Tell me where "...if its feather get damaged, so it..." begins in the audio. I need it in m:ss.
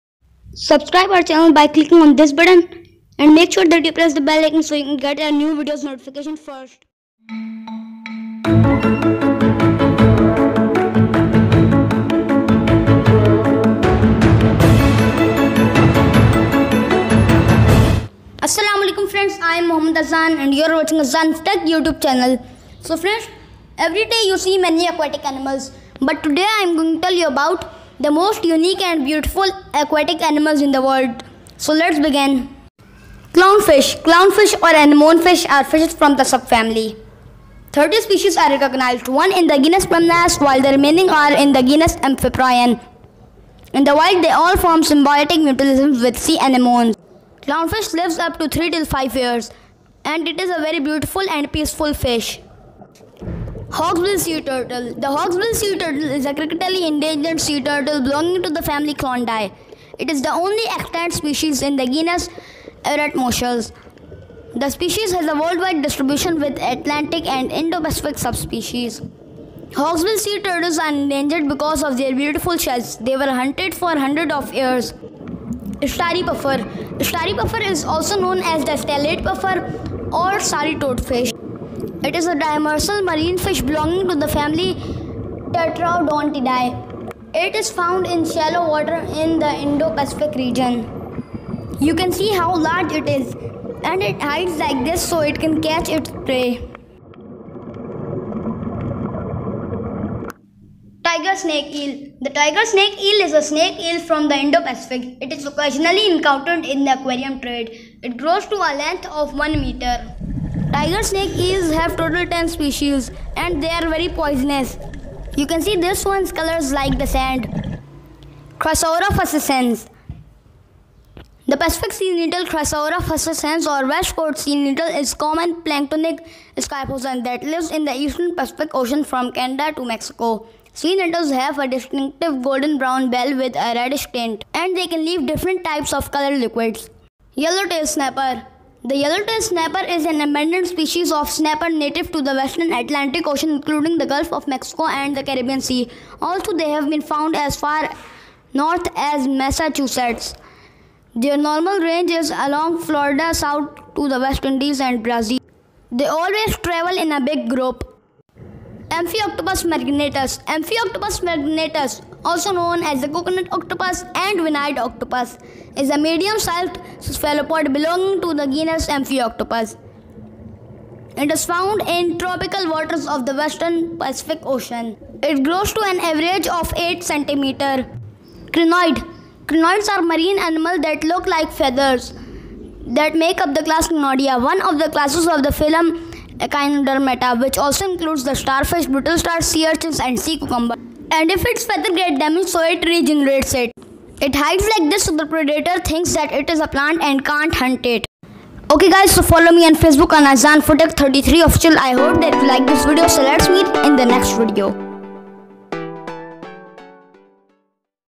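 3:11.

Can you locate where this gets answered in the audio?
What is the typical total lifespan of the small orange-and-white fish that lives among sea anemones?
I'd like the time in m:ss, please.
0:48.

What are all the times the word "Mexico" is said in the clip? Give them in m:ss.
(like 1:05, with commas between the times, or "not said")
2:09, 2:24.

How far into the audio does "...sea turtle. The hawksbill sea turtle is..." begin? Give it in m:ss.
0:54.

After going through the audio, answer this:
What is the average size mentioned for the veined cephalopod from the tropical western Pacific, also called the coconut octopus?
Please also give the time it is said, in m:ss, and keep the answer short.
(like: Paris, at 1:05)
8 centimeters, at 2:56.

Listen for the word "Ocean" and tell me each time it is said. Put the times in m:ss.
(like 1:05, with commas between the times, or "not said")
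2:08, 2:23, 2:54.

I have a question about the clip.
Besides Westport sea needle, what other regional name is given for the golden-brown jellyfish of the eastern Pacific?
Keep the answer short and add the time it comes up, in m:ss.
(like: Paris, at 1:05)
Pacific sea needle, at 2:01.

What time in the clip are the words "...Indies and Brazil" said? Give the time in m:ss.
2:34.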